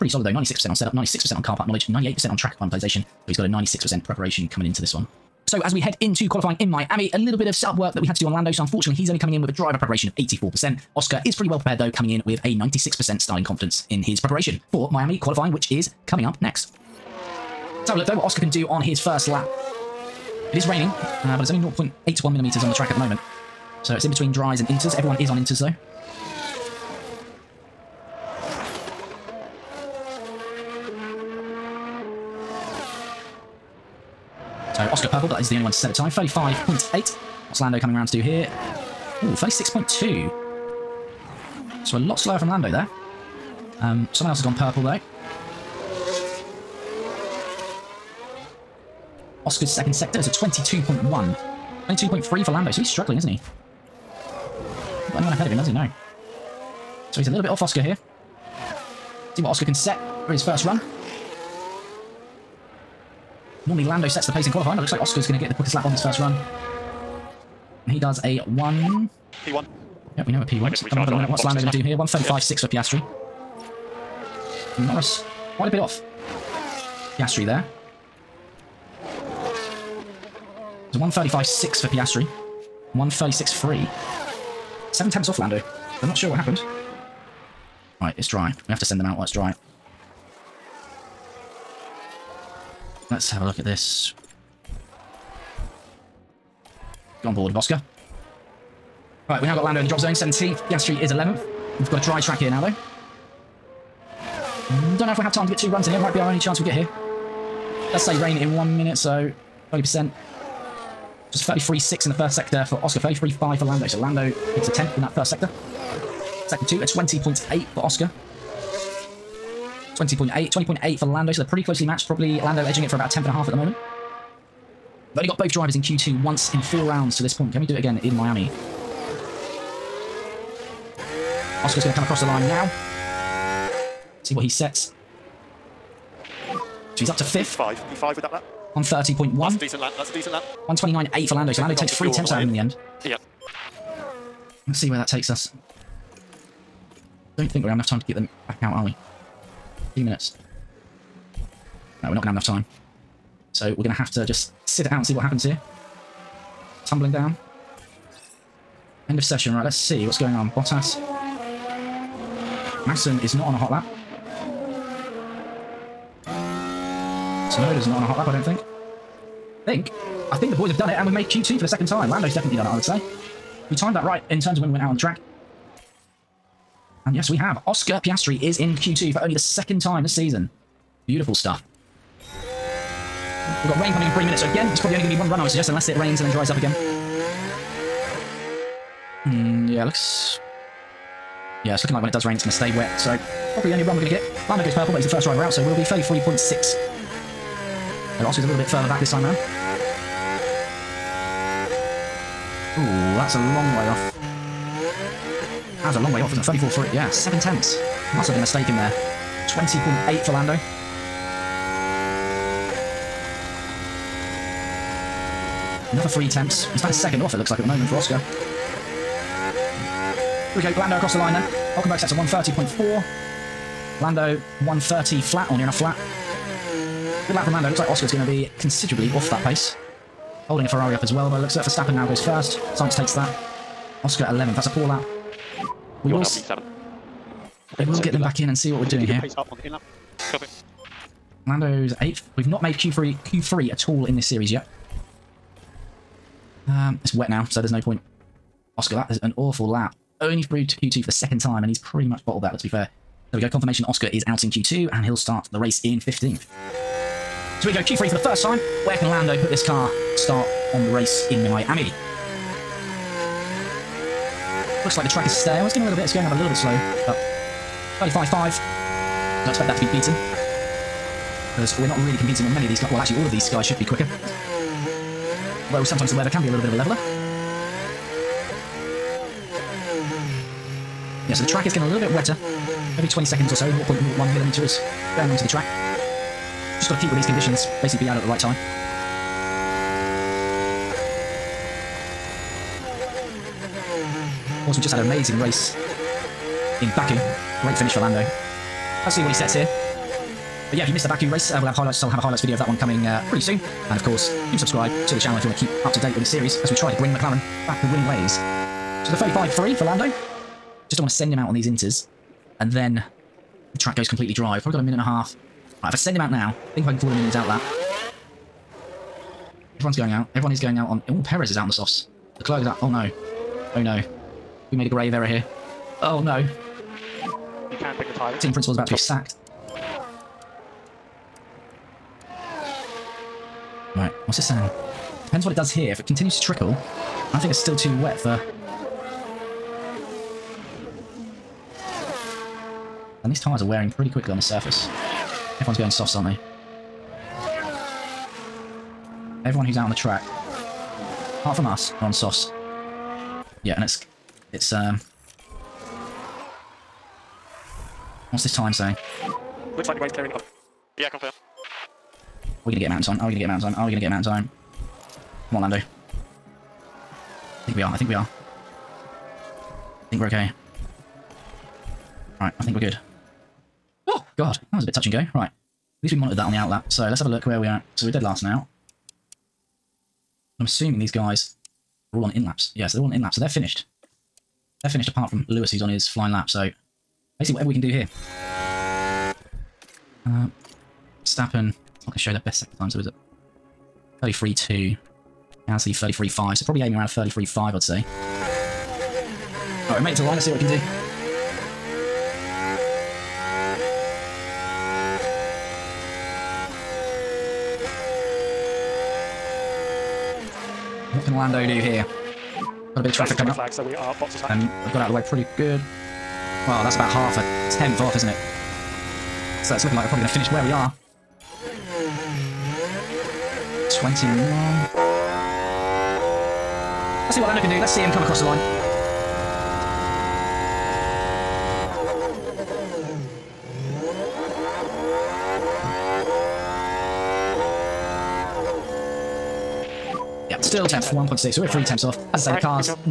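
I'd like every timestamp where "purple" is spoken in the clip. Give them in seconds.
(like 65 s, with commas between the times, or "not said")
35 s, 44 s, 194 s.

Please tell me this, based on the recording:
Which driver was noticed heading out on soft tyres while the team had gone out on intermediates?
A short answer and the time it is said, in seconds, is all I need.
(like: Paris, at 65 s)
Perez, at 321 s.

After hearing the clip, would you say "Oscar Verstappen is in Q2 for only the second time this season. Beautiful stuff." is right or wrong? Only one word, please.
wrong.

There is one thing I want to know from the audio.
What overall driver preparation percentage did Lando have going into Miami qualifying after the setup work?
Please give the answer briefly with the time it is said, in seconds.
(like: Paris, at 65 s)
84%, at 10 s.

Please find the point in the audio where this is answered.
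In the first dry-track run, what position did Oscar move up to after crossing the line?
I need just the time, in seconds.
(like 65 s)
137 s.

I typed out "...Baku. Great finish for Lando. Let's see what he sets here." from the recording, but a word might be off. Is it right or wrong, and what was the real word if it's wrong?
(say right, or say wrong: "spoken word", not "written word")
right.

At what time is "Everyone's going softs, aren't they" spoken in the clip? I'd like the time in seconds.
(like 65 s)
345 s.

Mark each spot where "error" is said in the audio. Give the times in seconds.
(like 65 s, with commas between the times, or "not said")
325 s.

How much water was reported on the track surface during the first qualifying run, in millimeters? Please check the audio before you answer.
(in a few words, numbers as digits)
0.81 millimeters.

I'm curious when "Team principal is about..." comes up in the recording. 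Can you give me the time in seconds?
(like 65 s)
328 s.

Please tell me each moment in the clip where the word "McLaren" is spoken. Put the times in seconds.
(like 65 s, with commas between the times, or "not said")
307 s.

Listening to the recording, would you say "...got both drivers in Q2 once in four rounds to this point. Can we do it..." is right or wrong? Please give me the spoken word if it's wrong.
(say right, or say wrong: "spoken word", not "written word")
right.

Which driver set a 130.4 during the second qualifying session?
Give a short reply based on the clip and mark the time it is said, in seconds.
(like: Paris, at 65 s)
Hulkenberg, at 221 s.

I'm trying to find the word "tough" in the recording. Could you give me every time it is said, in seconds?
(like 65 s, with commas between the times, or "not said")
not said.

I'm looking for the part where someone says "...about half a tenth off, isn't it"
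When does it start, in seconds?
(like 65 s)
416 s.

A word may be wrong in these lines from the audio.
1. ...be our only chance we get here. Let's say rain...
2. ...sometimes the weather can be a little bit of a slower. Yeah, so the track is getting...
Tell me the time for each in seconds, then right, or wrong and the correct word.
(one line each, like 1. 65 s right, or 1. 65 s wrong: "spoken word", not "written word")
1. 106 s right
2. 275 s wrong: "leveler", not "slower".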